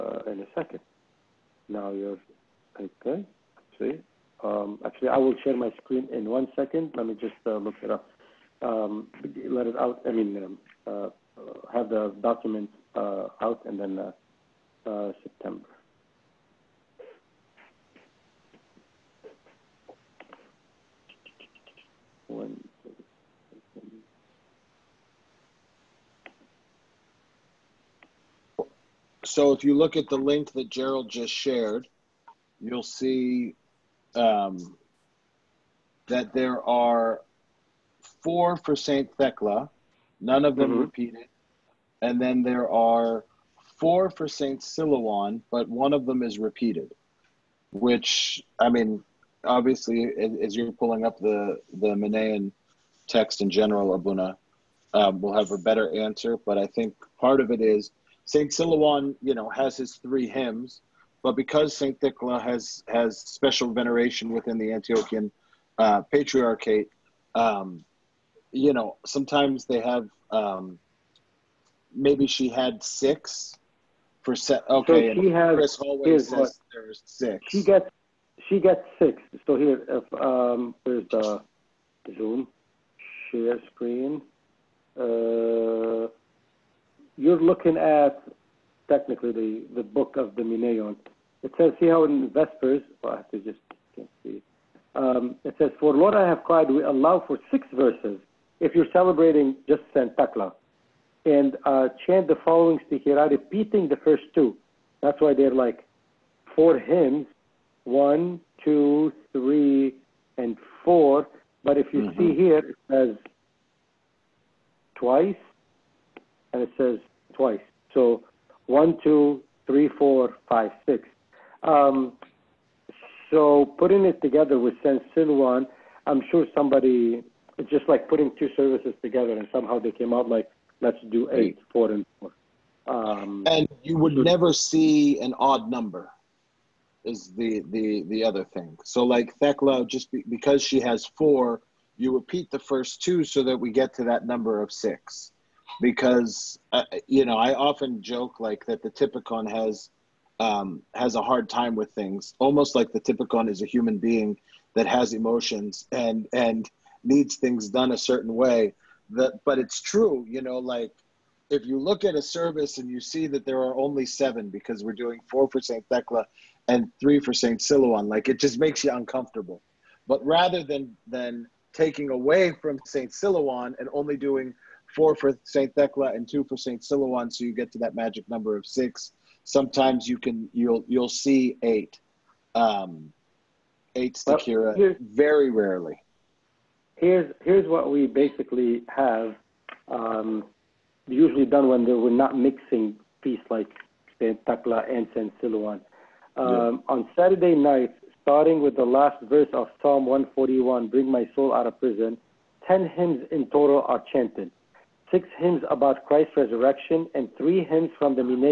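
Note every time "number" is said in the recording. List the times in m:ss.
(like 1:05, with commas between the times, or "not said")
2:15, 2:24, 2:58.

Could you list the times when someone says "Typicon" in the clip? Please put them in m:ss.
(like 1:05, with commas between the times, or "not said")
2:28, 2:32.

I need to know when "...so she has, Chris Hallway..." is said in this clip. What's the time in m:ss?
1:15.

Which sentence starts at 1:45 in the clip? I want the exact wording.
That's why they're like four hymns, one, two, three, and four.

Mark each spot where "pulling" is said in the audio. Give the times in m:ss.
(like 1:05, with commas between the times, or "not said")
0:50.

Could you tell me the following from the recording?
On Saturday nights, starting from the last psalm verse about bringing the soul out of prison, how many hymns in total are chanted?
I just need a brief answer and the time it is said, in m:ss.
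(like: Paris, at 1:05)
10, at 3:22.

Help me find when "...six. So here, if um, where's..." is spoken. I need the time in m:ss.
1:18.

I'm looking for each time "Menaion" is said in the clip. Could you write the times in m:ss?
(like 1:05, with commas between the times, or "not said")
0:51, 1:30.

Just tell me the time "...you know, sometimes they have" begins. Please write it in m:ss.
1:08.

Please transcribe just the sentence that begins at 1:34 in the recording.
Um, it says, for Lord I have cried, we allow for six verses if you're celebrating just Saint Thecla.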